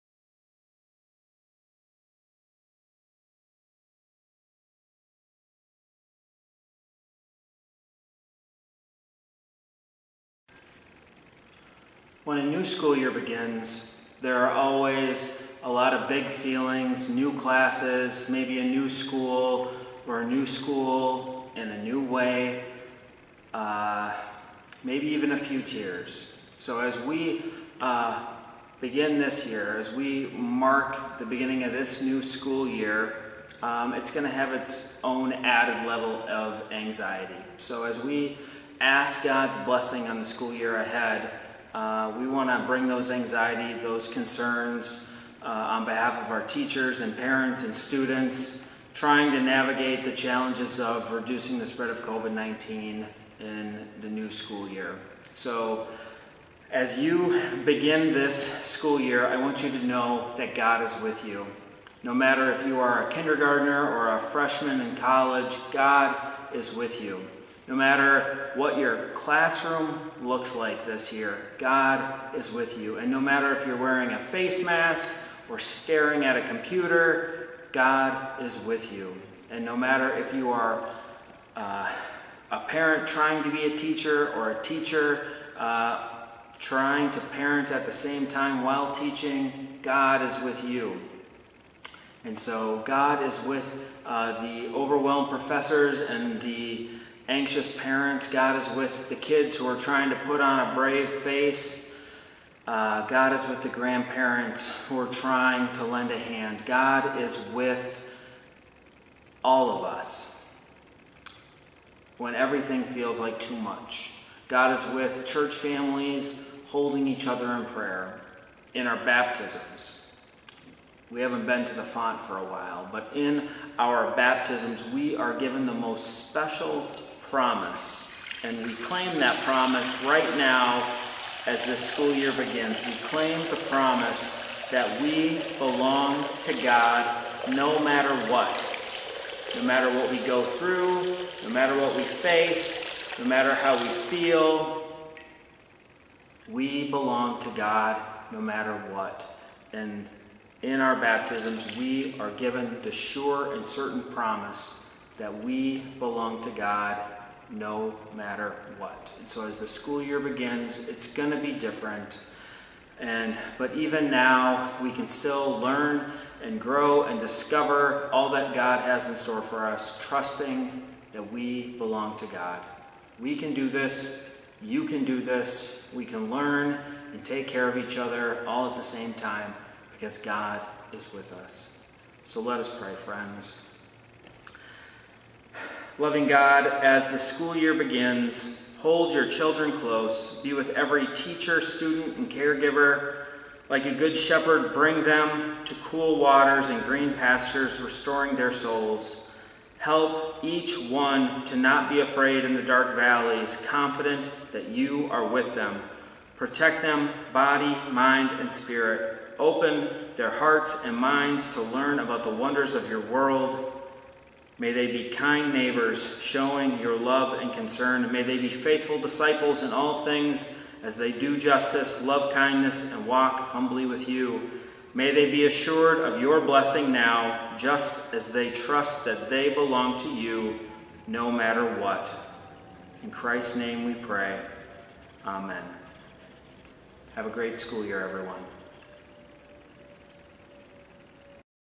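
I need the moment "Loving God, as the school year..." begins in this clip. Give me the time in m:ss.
3:06.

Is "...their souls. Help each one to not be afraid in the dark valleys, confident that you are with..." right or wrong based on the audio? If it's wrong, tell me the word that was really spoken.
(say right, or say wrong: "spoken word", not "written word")
right.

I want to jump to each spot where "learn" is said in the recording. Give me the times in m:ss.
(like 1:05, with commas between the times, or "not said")
2:45, 2:56, 3:31.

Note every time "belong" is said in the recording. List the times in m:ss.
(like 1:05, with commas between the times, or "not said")
2:15, 2:26, 2:35, 2:51, 3:49.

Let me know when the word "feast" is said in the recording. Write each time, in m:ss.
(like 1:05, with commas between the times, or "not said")
not said.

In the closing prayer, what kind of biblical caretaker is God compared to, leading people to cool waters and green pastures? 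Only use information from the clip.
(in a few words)
good shepherd.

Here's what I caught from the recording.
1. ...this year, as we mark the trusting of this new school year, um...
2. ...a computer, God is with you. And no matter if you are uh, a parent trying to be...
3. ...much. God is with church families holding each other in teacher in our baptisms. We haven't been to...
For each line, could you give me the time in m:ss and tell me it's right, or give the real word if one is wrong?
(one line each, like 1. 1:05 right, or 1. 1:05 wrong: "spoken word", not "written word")
1. 0:29 wrong: "beginning", not "trusting"
2. 1:16 right
3. 1:53 wrong: "prayer", not "teacher".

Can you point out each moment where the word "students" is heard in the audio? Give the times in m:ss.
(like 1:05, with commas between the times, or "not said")
0:47, 3:11.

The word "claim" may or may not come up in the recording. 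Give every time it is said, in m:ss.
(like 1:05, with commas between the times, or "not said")
2:08, 2:13.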